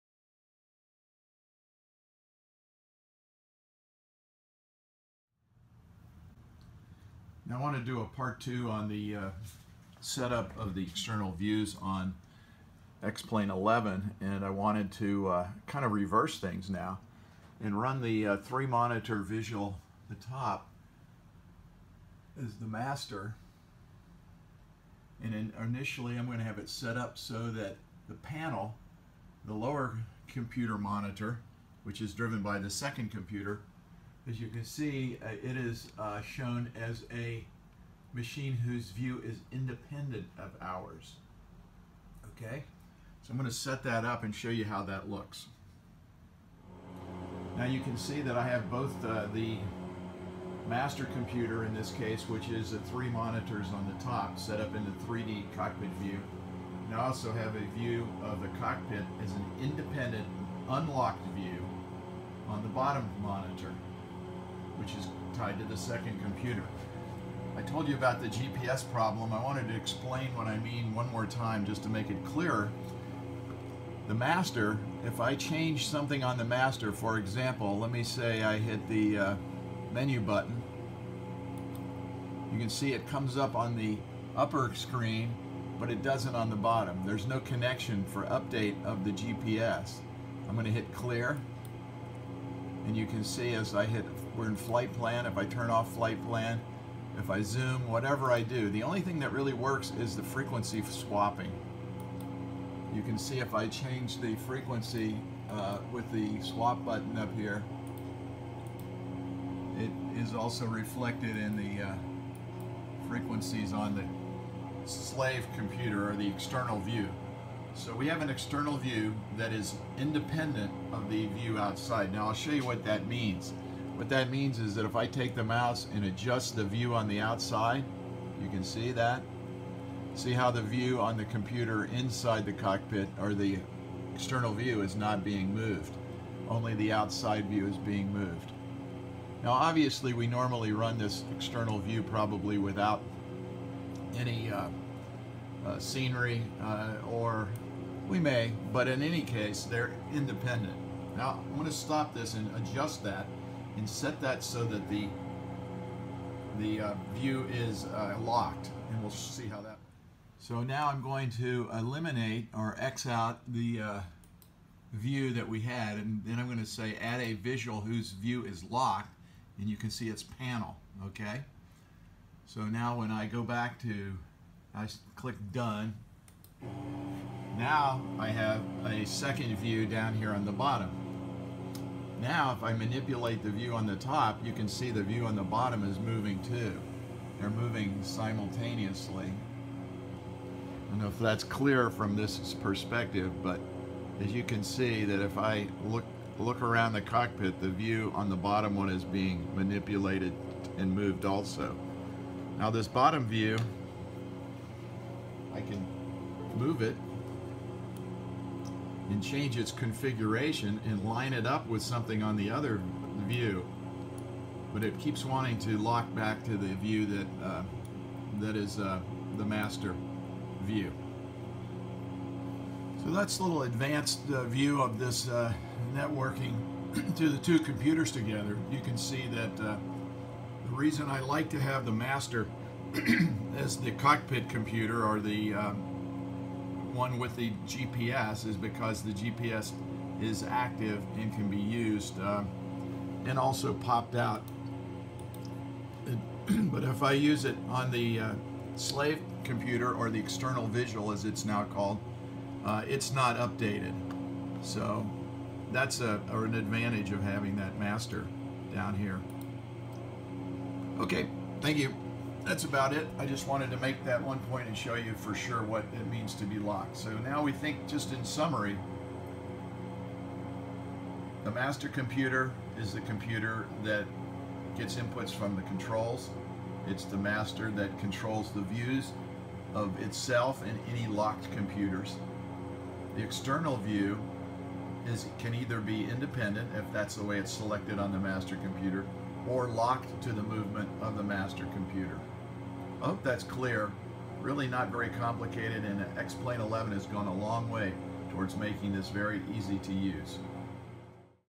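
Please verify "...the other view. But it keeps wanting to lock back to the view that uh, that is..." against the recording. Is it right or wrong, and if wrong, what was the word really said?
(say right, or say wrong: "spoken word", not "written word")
right.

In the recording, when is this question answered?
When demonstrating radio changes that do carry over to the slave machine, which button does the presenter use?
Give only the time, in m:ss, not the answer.
1:46.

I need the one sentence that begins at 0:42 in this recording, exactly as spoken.
Okay, so I'm going to set that up and show you how that looks.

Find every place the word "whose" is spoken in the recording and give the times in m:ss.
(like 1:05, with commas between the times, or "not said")
0:38, 2:47.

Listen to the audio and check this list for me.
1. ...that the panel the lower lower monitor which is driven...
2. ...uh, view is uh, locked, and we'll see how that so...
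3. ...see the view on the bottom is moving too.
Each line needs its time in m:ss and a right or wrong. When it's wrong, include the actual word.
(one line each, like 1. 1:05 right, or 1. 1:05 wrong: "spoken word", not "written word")
1. 0:27 wrong: "computer", not "lower"
2. 2:36 right
3. 3:04 right.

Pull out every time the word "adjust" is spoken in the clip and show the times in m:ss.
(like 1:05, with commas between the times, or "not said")
2:06, 2:32.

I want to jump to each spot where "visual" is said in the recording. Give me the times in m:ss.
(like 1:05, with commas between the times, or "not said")
0:19, 2:47, 4:10.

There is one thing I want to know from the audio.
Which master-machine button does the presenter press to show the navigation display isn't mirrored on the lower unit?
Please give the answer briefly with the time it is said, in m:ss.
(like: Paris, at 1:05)
menu button, at 1:19.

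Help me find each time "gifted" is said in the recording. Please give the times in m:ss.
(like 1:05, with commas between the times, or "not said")
not said.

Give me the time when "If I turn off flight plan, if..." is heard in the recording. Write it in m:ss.
1:35.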